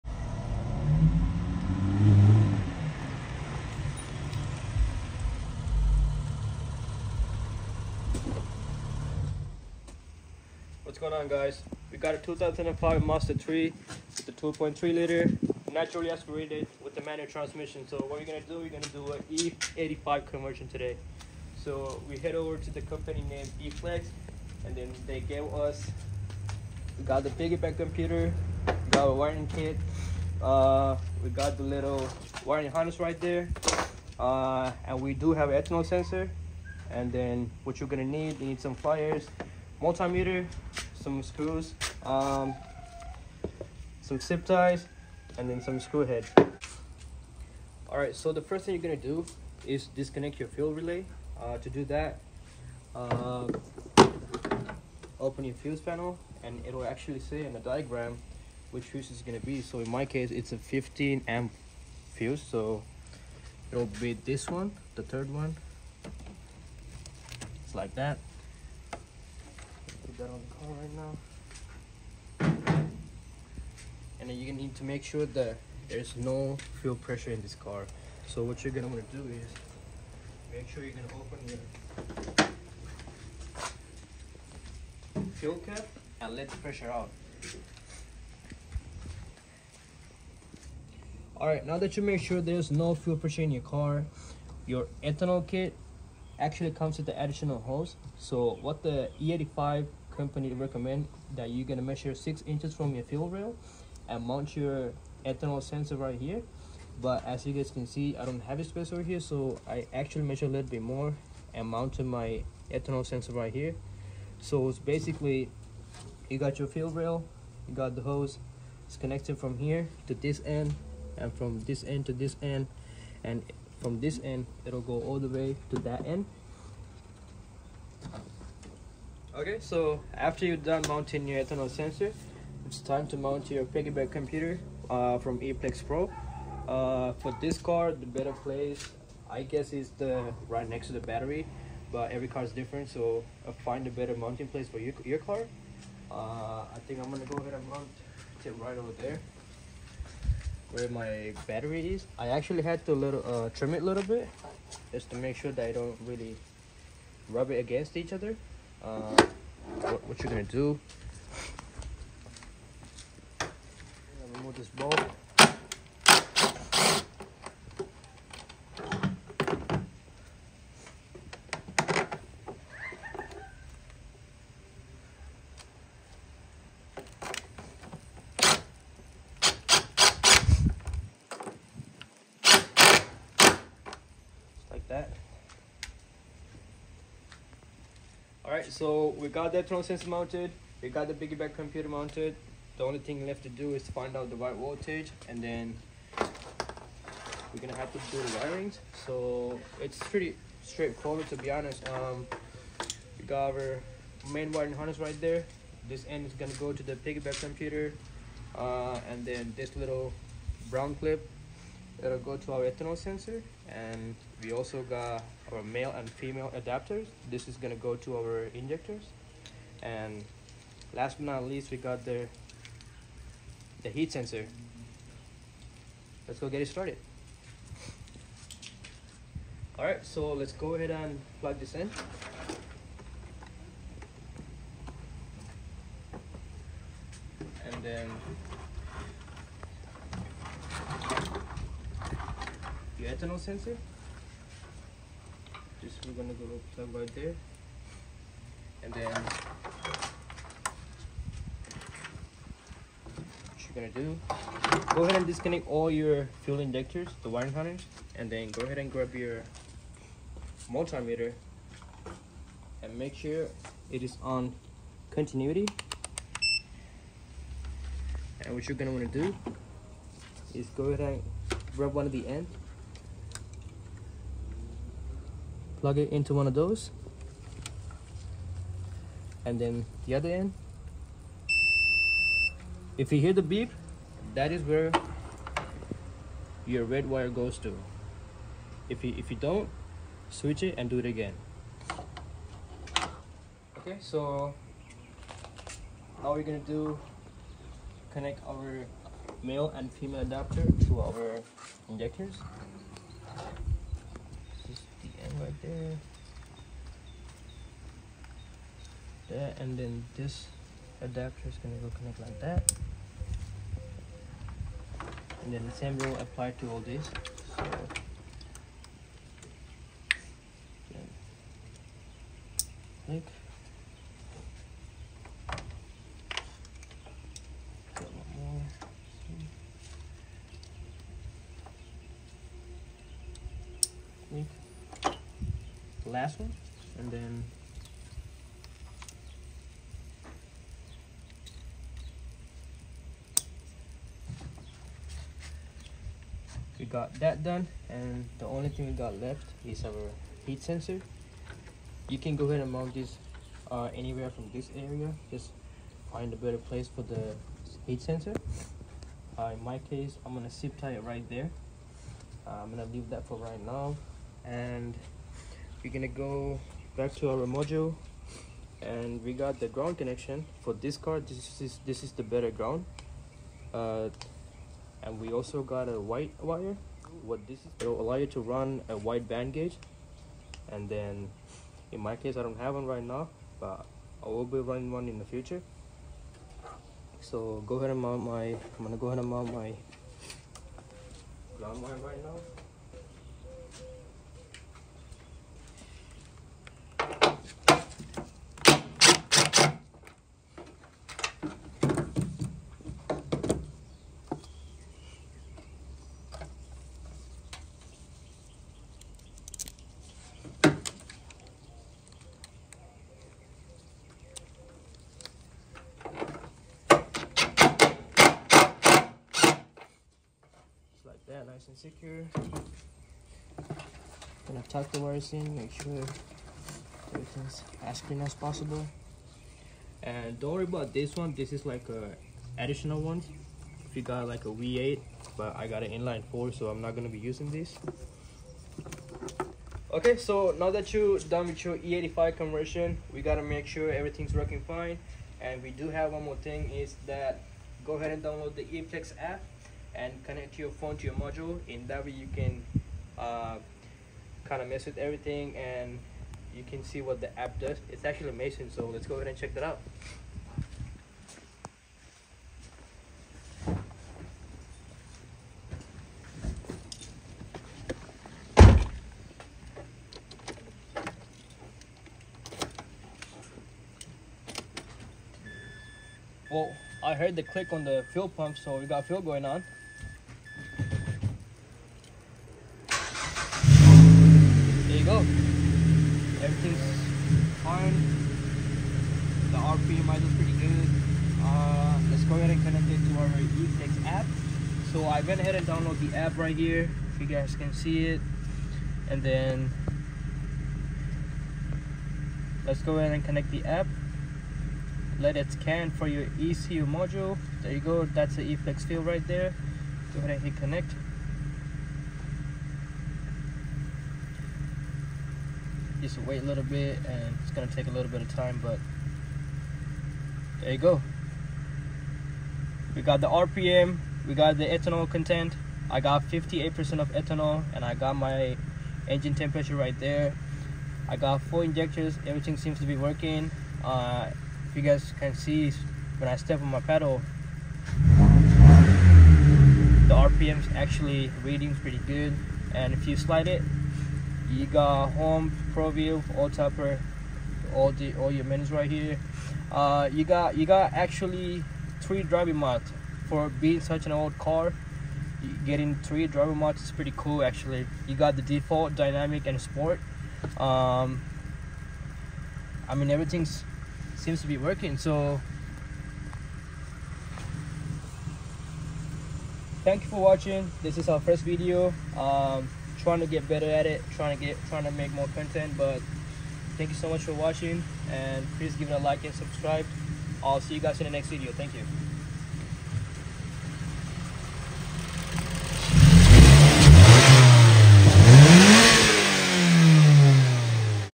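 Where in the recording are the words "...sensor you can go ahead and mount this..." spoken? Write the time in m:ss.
5:50.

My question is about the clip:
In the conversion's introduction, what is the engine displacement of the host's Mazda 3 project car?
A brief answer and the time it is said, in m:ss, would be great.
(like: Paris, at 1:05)
2.3 liter, at 0:14.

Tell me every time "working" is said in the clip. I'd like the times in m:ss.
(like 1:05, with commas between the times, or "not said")
7:24, 8:52, 9:24.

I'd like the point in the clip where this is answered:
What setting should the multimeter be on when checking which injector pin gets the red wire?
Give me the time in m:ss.
4:25.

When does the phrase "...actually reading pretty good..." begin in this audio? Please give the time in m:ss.
9:00.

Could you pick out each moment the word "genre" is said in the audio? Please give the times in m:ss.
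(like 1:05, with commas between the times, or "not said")
not said.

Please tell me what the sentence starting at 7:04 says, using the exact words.
Gonna tuck the wires in, make sure everything's as clean as possible.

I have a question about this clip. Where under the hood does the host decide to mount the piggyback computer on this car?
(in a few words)
Next to the battery.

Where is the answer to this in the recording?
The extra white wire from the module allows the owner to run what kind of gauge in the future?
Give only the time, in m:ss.
6:18.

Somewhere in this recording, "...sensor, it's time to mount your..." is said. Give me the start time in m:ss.
2:11.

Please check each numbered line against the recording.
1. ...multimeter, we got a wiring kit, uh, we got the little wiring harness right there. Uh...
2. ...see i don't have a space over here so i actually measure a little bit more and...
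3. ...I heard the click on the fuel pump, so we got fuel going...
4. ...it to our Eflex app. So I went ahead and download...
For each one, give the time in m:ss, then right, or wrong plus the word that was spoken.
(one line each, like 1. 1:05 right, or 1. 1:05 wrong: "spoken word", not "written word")
1. 0:27 wrong: "computer", not "multimeter"
2. 1:47 right
3. 7:57 right
4. 8:12 right.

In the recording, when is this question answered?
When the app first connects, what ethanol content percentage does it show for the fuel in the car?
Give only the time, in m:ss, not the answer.
8:46.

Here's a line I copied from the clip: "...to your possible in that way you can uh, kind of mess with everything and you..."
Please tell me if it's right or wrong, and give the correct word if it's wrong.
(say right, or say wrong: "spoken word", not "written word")
wrong: "module", not "possible".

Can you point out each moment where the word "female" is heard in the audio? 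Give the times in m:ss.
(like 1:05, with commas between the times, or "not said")
3:36, 4:59.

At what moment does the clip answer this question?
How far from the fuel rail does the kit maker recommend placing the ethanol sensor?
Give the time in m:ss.
1:42.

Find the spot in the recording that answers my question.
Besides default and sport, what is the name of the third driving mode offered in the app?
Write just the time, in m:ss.
9:18.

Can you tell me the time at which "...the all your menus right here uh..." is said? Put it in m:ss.
9:07.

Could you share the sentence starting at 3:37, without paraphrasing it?
This is gonna go to our injectors.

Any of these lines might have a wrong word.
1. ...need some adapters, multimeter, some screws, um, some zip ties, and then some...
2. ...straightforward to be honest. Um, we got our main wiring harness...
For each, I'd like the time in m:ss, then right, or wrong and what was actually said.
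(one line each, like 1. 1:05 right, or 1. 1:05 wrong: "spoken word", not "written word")
1. 0:38 wrong: "pliers", not "adapters"
2. 3:20 right.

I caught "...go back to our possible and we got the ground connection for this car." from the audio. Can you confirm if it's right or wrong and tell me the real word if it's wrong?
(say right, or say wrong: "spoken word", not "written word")
wrong: "module", not "possible".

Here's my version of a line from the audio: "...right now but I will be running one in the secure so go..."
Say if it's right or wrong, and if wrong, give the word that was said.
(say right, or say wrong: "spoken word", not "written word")
wrong: "future", not "secure".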